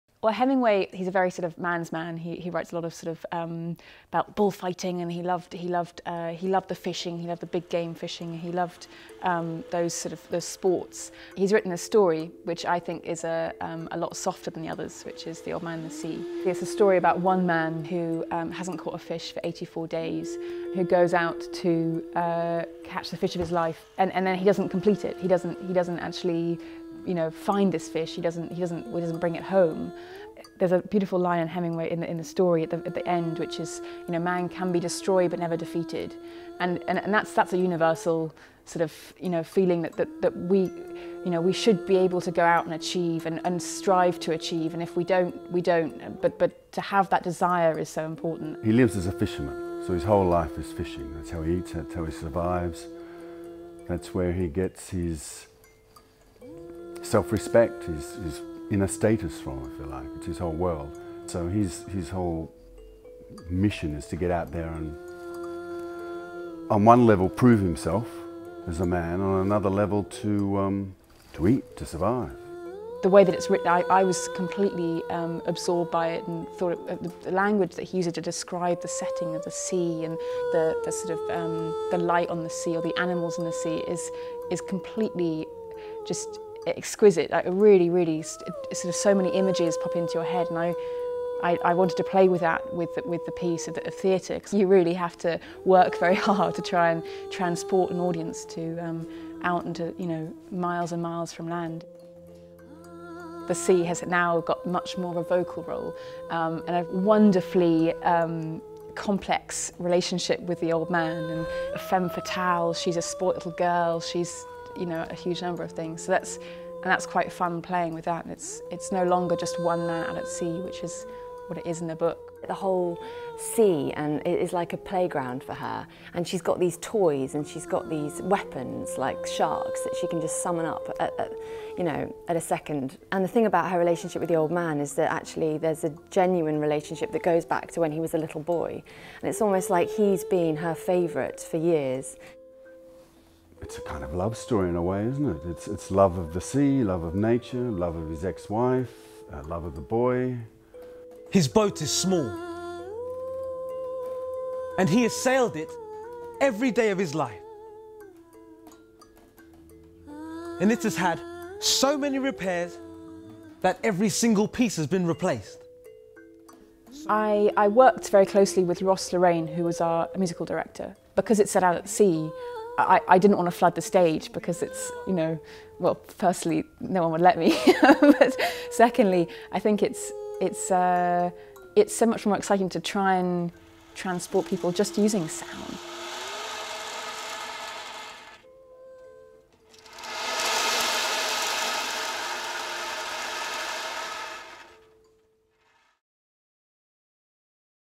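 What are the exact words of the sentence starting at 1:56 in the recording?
So that's, and that's quite fun playing with that.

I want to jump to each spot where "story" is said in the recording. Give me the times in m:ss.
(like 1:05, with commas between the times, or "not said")
0:11, 0:16, 0:32, 2:24.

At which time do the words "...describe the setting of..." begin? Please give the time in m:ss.
1:18.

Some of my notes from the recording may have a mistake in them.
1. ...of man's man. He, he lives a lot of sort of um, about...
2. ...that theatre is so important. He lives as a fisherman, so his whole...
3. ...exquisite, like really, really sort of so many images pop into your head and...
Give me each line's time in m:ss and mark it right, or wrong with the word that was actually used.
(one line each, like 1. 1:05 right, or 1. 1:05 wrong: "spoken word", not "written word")
1. 0:01 wrong: "writes", not "lives"
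2. 0:47 wrong: "desire", not "theatre"
3. 1:26 right.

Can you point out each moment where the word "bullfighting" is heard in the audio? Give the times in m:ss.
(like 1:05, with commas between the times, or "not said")
0:04.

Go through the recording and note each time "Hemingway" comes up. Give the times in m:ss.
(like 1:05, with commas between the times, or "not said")
0:00, 0:31.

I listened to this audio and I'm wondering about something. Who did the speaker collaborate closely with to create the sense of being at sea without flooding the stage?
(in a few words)
Ross Lorraine.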